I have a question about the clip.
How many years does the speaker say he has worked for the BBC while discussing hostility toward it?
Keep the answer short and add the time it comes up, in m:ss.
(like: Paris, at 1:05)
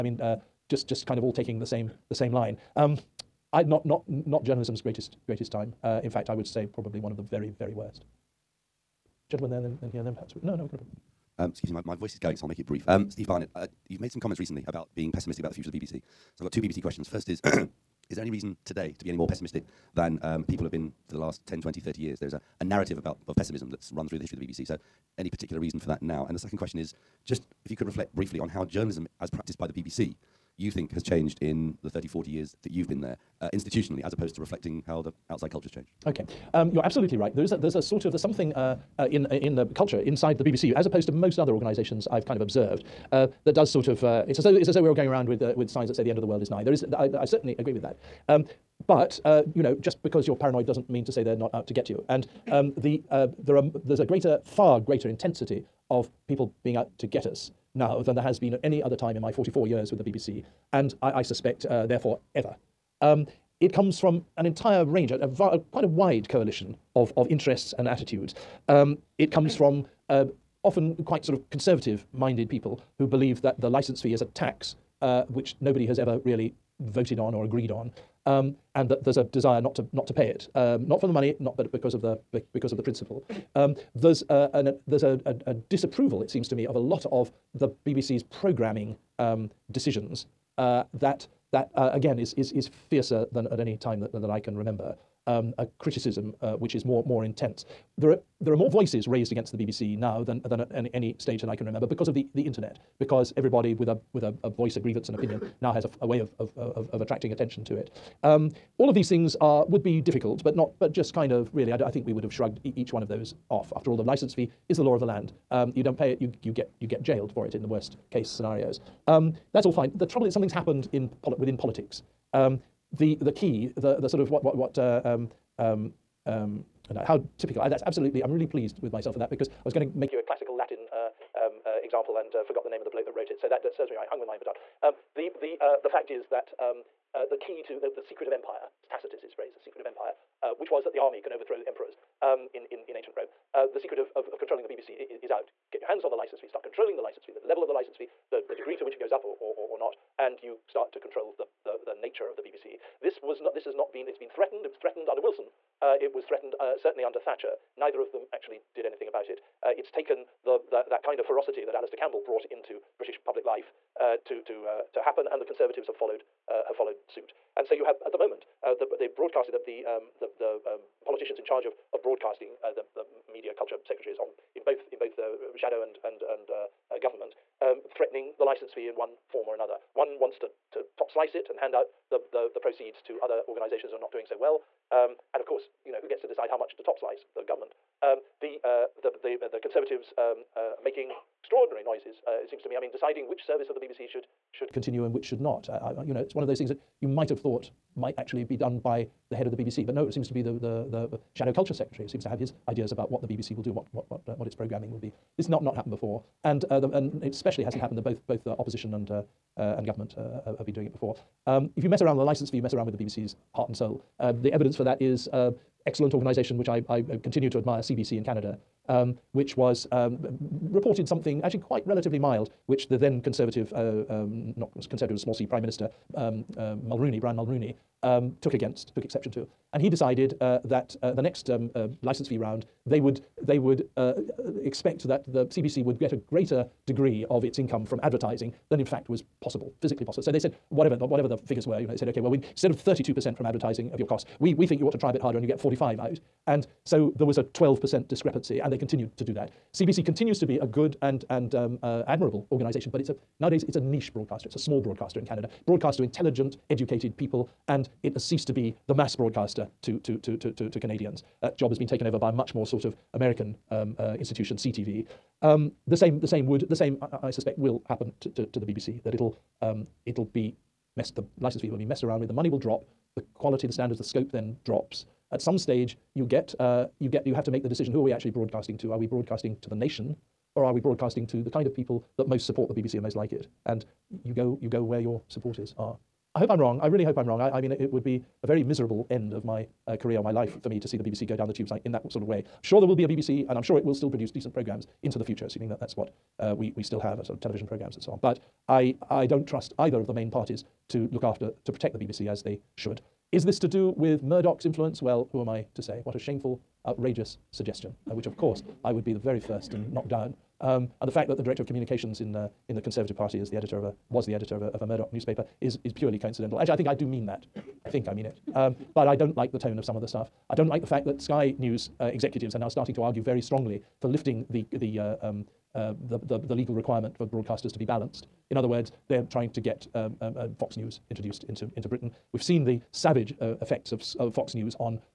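44, at 0:59.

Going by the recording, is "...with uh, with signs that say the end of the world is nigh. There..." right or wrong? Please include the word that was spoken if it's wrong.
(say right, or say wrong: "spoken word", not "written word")
right.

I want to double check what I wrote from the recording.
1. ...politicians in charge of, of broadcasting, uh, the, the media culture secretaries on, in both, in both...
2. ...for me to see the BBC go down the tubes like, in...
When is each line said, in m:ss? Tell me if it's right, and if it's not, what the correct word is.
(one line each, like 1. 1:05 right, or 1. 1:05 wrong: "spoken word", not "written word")
1. 2:51 right
2. 4:50 right.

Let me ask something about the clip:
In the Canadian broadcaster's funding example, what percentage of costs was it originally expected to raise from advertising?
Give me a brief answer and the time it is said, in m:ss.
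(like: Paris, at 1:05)
32%, at 4:02.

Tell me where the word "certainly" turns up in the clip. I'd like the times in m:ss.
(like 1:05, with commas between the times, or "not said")
0:47, 2:36.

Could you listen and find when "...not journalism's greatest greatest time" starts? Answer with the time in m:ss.
0:04.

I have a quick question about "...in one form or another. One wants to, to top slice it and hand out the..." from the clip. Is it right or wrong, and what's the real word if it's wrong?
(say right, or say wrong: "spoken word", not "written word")
right.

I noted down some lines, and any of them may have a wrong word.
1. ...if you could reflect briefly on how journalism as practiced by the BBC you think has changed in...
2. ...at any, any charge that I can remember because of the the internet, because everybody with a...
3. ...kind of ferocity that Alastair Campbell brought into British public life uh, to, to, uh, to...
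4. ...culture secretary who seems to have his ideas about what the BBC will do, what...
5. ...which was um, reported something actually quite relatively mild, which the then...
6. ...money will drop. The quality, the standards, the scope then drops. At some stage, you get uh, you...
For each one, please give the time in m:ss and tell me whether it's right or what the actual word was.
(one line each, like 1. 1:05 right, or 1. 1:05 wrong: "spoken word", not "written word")
1. 0:27 right
2. 1:40 wrong: "stage", not "charge"
3. 2:41 right
4. 3:21 right
5. 3:39 right
6. 4:32 right.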